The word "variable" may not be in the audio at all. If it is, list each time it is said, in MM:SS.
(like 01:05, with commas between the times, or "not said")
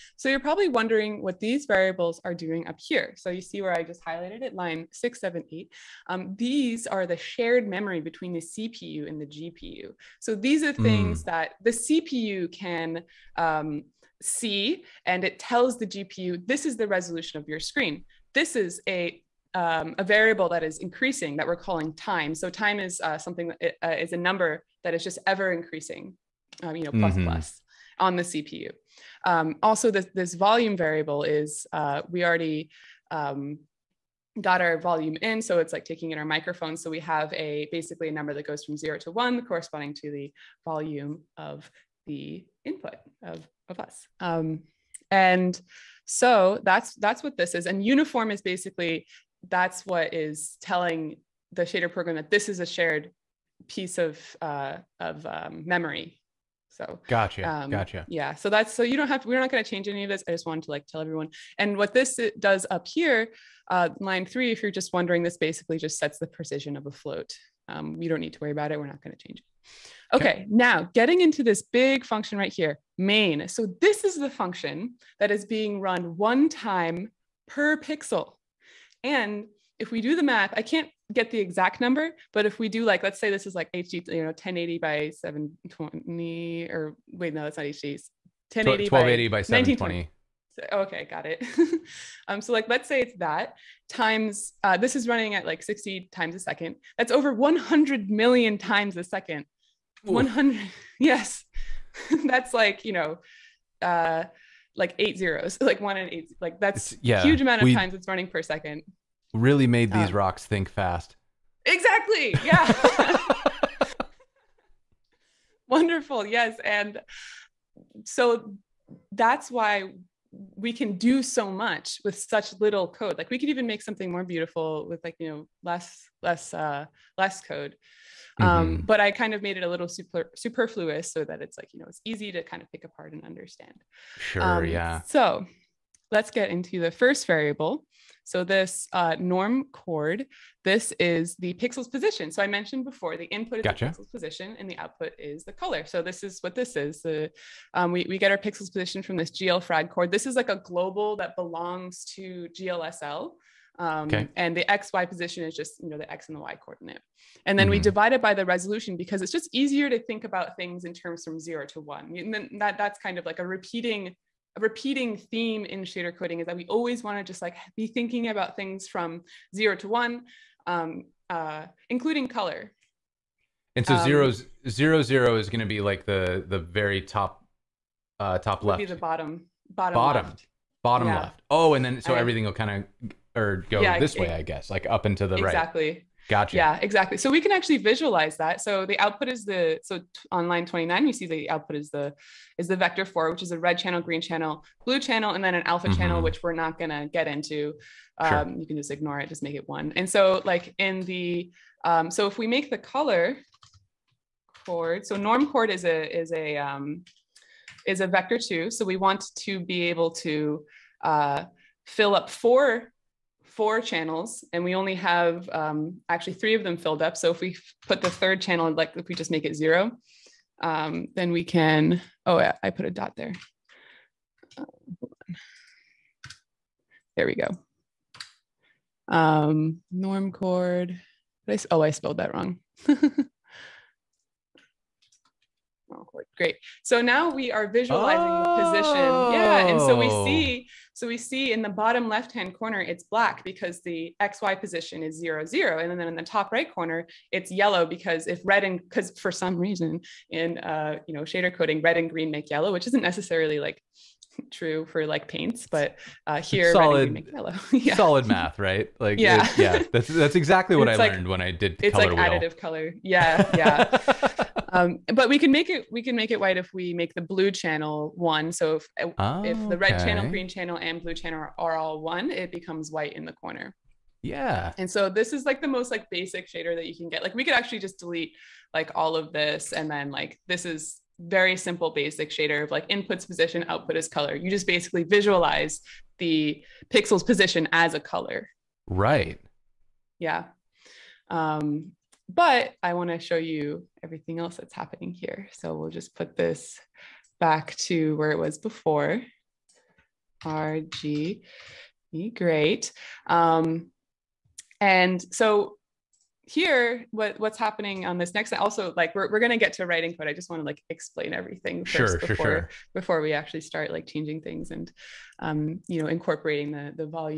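00:01, 00:20, 00:30, 02:17.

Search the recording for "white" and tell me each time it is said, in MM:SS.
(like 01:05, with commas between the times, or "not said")
04:26, 04:32.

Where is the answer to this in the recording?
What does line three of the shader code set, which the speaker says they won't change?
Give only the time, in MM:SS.
01:06.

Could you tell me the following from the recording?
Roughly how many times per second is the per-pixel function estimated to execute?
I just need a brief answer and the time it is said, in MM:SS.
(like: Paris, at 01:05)
over 100 million, at 01:37.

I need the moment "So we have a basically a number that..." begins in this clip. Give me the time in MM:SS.
00:36.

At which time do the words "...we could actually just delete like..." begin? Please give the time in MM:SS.
04:37.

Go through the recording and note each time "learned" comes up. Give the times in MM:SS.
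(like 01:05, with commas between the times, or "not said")
04:21.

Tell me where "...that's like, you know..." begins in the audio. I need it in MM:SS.
01:42.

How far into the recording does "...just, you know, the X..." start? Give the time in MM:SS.
02:35.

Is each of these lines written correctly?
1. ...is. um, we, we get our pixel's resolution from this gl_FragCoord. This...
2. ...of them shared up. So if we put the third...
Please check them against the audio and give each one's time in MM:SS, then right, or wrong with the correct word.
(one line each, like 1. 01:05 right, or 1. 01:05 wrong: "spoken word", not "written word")
1. 02:26 wrong: "position", not "resolution"
2. 03:36 wrong: "filled", not "shared".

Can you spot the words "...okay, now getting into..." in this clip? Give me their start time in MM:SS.
01:10.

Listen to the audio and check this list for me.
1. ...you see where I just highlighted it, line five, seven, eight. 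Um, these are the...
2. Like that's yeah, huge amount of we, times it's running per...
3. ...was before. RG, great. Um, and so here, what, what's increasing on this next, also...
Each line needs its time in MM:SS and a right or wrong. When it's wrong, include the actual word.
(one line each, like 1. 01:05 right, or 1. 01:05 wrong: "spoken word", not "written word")
1. 00:03 wrong: "six", not "five"
2. 01:46 right
3. 04:58 wrong: "happening", not "increasing".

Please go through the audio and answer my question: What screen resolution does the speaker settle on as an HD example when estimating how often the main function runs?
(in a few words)
1280 by 720.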